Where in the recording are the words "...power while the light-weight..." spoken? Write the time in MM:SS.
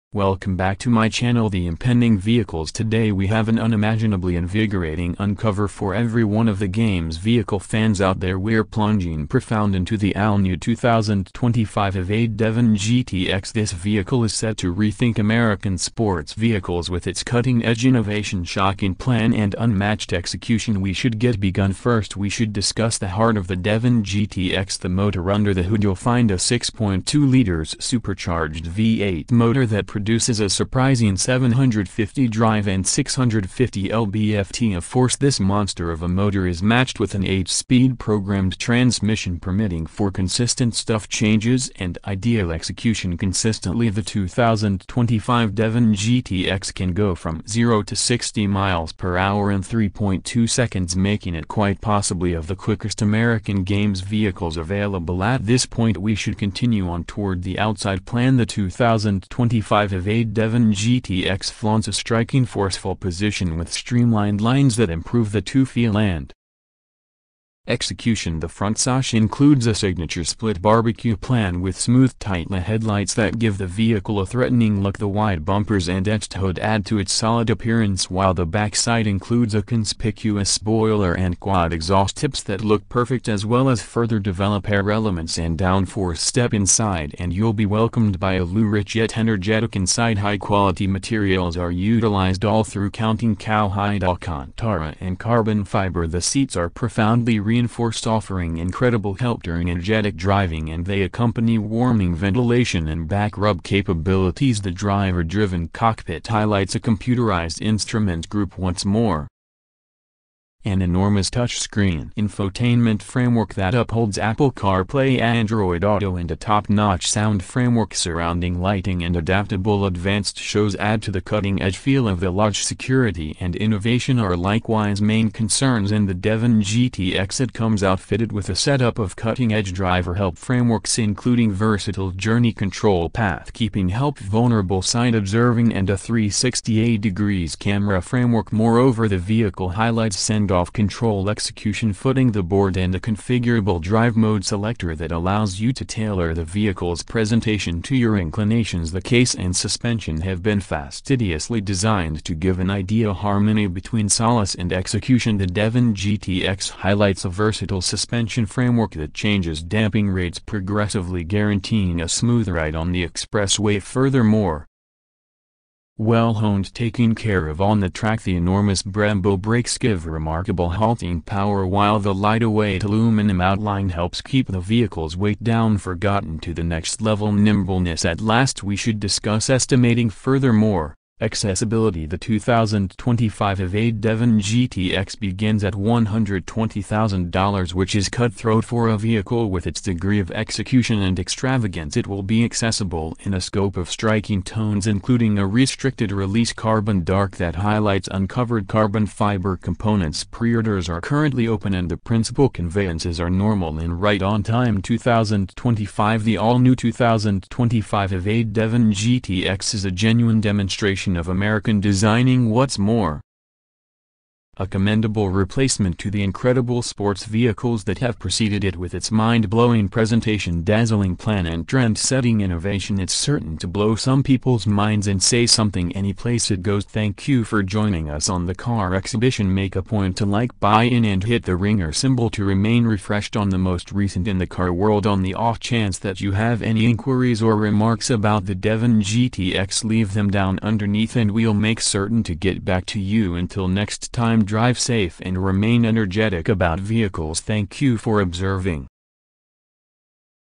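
02:51.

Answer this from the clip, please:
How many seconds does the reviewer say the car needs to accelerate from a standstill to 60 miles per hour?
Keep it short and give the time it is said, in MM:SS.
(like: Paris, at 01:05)
3.2 seconds, at 00:49.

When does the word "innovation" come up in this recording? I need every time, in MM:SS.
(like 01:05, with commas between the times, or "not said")
00:17, 02:03, 03:42.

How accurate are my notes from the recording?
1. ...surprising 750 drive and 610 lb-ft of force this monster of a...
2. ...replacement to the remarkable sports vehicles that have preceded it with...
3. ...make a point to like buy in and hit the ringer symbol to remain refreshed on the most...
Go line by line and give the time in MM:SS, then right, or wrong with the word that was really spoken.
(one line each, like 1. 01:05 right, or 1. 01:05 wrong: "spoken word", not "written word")
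1. 00:30 wrong: "650", not "610"
2. 03:35 wrong: "incredible", not "remarkable"
3. 03:49 right.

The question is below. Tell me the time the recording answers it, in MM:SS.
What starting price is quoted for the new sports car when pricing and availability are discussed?
03:05.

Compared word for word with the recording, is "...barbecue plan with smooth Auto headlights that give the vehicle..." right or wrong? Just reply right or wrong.
wrong.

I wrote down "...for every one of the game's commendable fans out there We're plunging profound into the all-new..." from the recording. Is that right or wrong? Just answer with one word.
wrong.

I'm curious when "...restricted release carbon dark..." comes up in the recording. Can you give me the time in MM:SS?
03:15.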